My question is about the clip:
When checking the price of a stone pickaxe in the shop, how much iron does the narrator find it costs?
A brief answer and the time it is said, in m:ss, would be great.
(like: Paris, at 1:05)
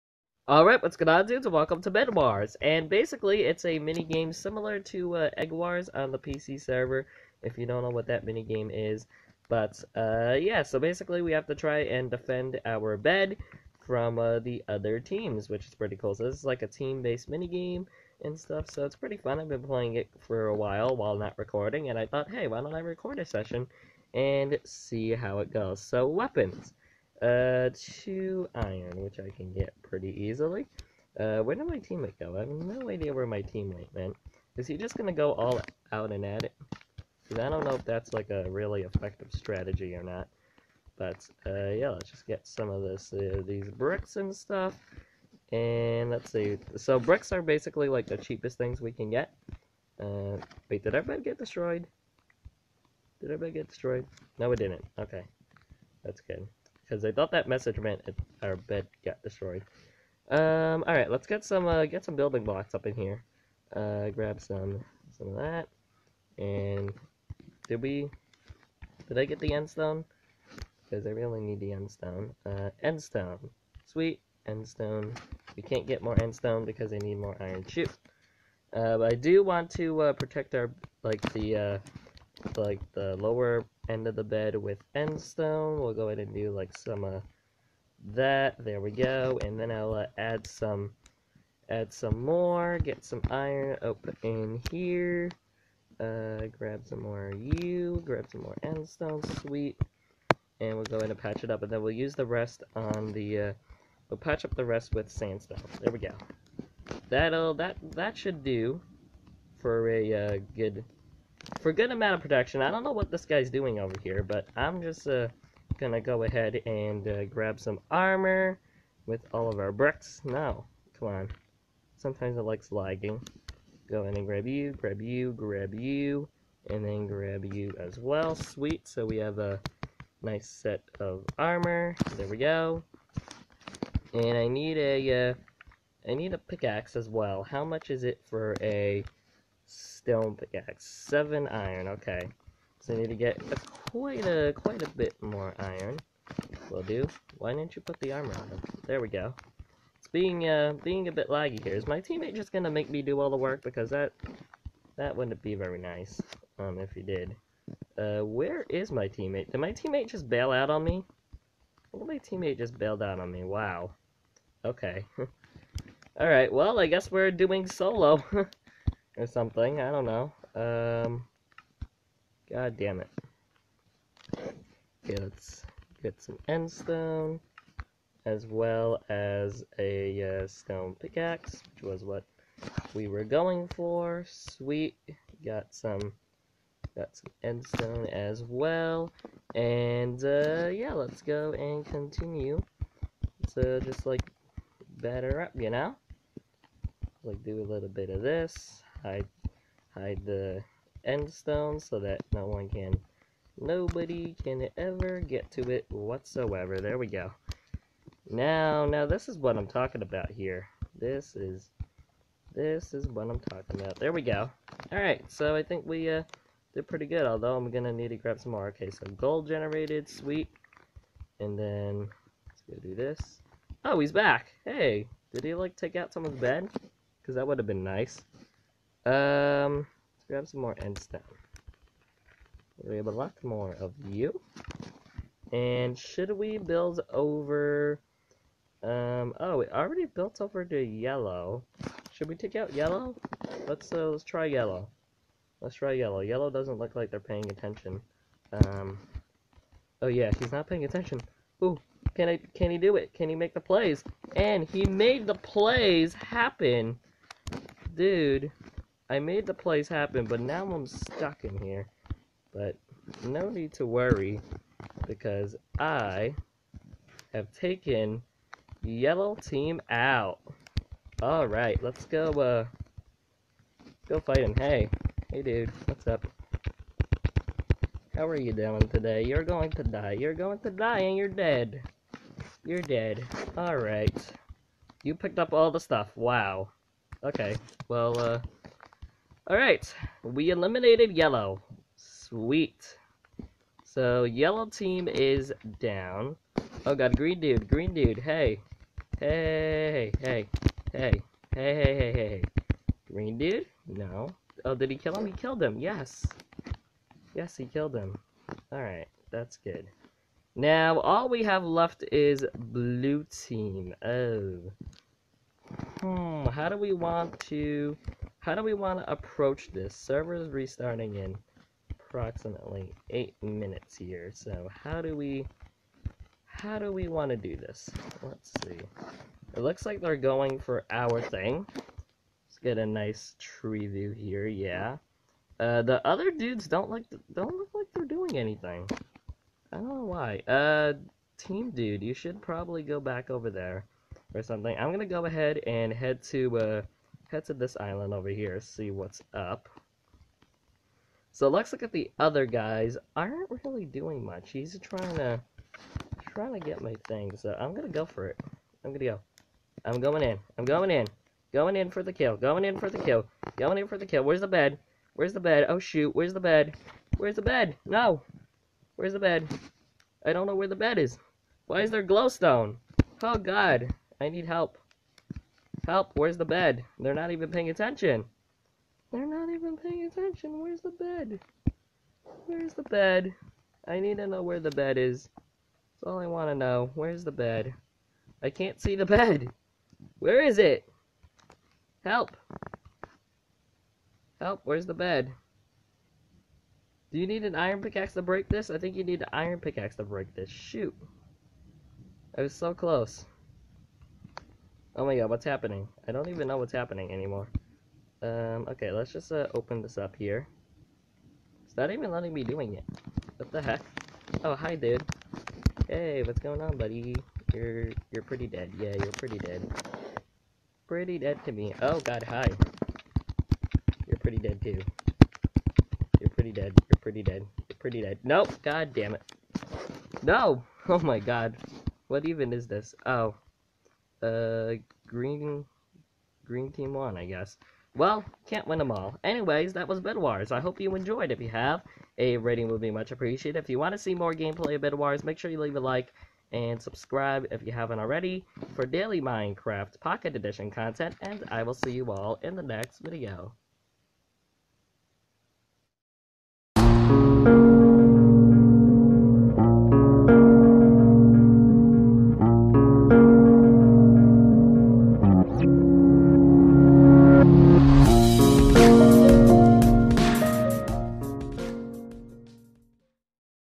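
7 iron, at 2:20.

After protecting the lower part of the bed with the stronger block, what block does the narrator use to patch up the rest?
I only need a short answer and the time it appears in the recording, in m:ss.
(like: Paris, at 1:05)
Sandstone, at 1:45.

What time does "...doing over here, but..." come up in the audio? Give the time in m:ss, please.
1:53.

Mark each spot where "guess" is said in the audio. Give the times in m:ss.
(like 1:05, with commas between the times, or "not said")
2:46, 7:17.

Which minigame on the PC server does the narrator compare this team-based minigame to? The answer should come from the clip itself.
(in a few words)
Egg Wars.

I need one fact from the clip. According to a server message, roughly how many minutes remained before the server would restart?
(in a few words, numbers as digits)
8 minutes.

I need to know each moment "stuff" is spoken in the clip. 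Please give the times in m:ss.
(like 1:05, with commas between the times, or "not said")
0:18, 0:44, 4:45.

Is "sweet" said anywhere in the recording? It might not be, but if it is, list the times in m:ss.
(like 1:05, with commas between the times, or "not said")
1:13, 1:39, 2:08, 3:04, 3:40, 4:51.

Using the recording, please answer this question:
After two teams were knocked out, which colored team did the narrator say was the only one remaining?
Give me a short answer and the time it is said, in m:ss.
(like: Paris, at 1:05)
Blue team, at 5:12.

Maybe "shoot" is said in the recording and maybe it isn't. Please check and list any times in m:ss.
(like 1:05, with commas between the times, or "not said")
1:17, 6:05, 6:40.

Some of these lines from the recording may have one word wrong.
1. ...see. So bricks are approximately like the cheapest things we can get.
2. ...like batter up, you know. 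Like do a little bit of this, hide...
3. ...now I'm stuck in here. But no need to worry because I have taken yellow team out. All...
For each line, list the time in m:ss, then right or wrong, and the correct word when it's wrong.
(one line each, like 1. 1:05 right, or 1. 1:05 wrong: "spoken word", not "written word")
1. 0:46 wrong: "basically", not "approximately"
2. 3:14 right
3. 4:20 right.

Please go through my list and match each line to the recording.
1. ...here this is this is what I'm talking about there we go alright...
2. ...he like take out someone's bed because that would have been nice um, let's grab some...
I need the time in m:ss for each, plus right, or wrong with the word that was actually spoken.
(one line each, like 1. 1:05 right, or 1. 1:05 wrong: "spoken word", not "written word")
1. 3:30 right
2. 3:45 right.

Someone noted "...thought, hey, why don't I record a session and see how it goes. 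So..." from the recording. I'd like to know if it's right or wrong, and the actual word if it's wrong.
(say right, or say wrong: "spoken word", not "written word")
right.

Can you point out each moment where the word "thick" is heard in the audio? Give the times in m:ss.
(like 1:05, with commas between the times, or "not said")
not said.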